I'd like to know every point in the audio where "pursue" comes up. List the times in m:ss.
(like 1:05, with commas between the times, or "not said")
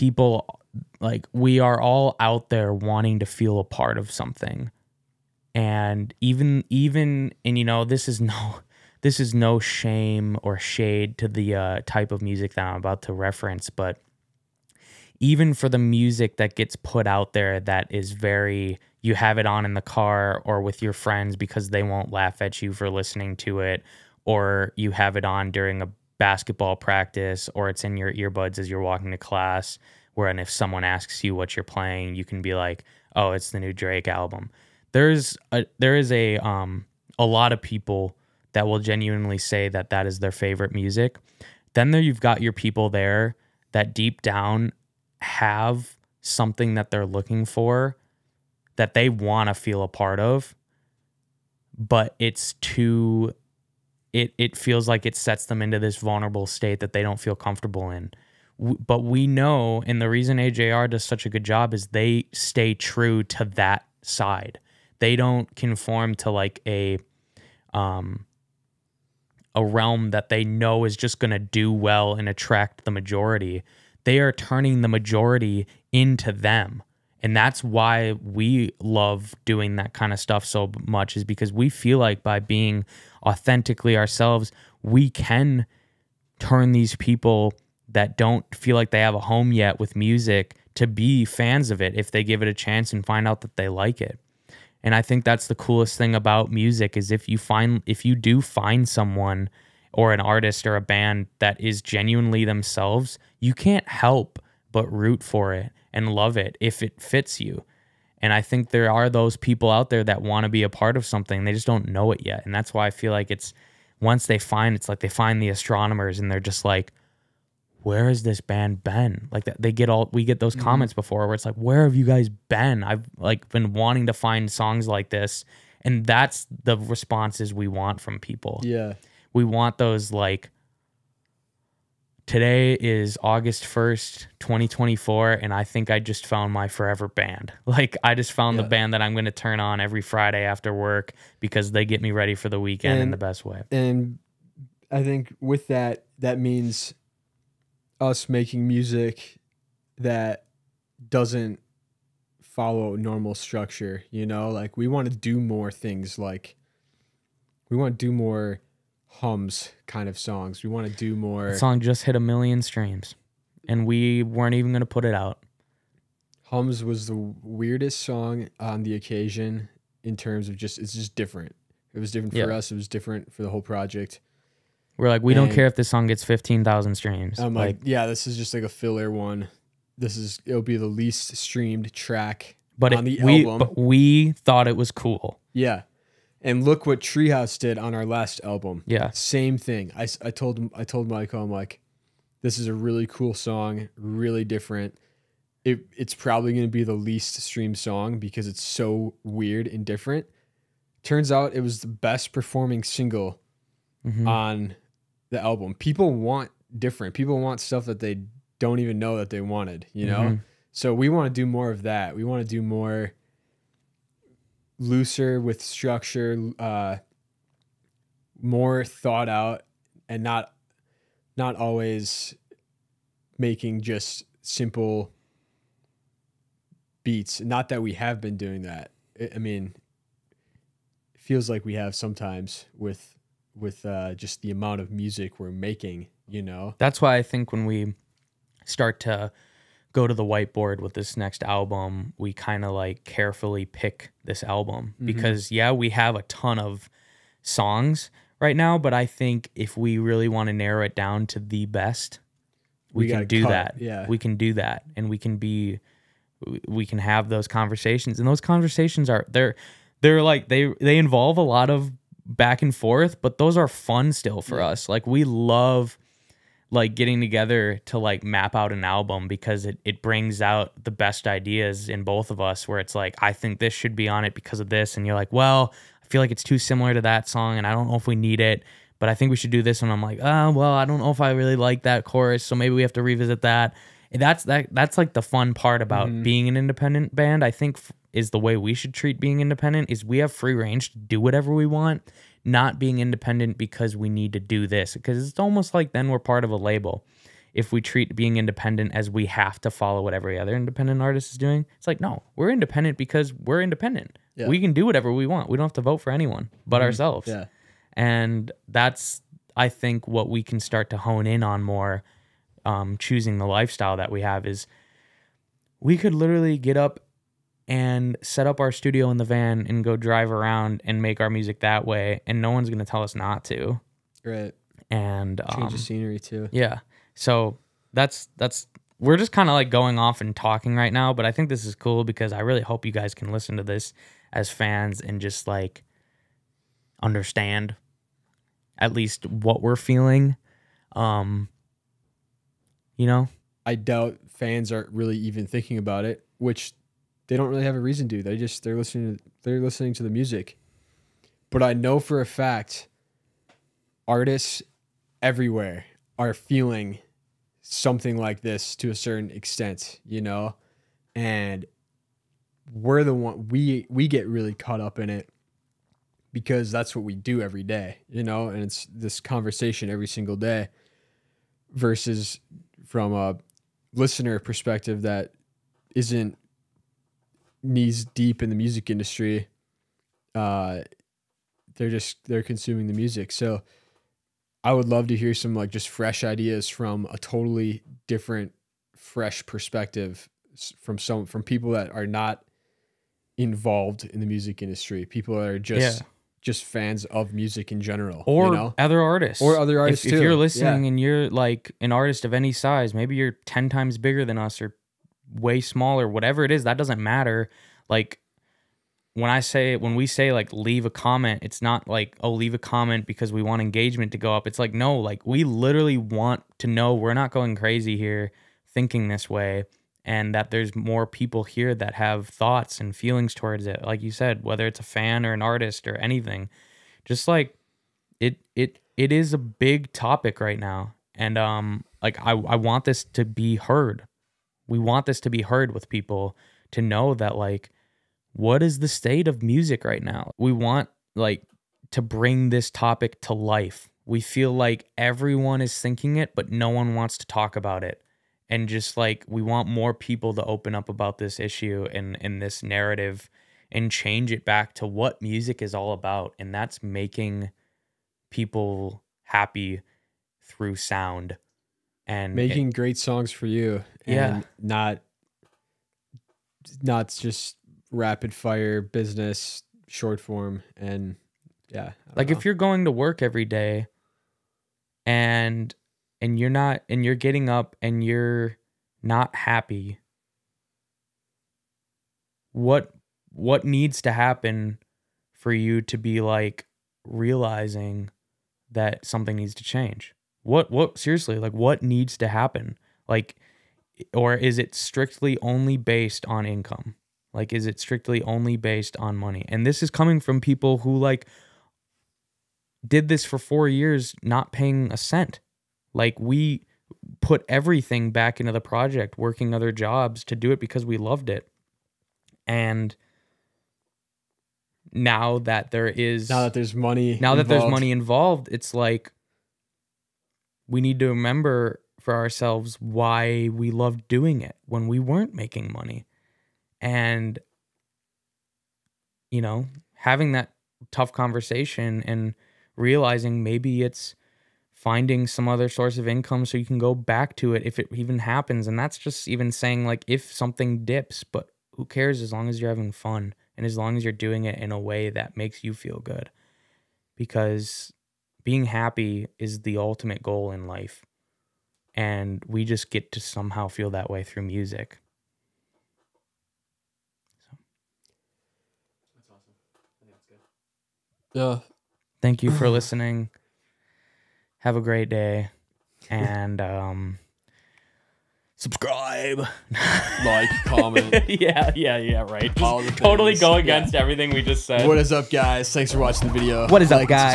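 not said.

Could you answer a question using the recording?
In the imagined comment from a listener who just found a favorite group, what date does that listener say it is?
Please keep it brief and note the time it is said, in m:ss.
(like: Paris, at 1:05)
August 1st, 2024, at 2:13.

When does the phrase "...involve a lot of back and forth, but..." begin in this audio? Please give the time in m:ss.
4:20.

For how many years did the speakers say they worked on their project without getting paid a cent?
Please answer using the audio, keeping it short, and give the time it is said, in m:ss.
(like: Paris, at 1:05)
4 years, at 8:23.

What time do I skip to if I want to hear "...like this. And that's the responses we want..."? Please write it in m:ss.
2:04.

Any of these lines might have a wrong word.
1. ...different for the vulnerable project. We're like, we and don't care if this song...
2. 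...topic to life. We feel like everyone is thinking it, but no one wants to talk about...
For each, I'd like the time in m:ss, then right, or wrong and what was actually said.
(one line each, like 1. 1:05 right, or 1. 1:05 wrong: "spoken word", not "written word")
1. 2:52 wrong: "whole", not "vulnerable"
2. 7:22 right.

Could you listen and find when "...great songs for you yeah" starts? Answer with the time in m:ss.
7:42.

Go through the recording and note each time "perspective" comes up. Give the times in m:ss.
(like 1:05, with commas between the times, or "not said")
6:14, 6:29.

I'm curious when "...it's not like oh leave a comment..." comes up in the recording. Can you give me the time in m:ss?
6:51.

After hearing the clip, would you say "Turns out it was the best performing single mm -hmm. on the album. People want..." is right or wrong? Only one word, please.
right.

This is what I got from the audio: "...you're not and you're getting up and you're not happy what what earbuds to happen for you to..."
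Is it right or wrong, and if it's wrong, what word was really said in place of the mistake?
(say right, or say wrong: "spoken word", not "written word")
wrong: "needs", not "earbuds".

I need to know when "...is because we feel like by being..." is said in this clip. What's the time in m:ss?
1:21.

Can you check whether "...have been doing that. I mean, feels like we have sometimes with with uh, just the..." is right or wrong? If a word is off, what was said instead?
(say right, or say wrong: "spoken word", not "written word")
right.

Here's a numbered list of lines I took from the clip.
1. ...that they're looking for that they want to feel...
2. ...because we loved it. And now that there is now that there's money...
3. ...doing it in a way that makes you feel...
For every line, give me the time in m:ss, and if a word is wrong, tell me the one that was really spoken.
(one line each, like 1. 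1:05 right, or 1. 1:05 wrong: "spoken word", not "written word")
1. 0:46 right
2. 8:30 right
3. 9:04 right.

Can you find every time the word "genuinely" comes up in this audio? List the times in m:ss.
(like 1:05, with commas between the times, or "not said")
0:38, 1:41.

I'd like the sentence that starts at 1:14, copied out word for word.
They are turning the majority into them.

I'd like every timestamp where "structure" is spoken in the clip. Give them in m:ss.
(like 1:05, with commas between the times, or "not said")
2:33, 3:35.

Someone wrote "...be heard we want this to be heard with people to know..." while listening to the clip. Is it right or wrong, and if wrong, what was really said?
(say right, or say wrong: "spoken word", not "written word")
right.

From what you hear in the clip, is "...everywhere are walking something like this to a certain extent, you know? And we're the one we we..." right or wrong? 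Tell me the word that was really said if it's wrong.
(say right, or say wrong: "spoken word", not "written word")
wrong: "feeling", not "walking".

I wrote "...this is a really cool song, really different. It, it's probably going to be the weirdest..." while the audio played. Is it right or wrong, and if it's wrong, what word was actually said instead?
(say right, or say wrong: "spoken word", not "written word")
wrong: "least", not "weirdest".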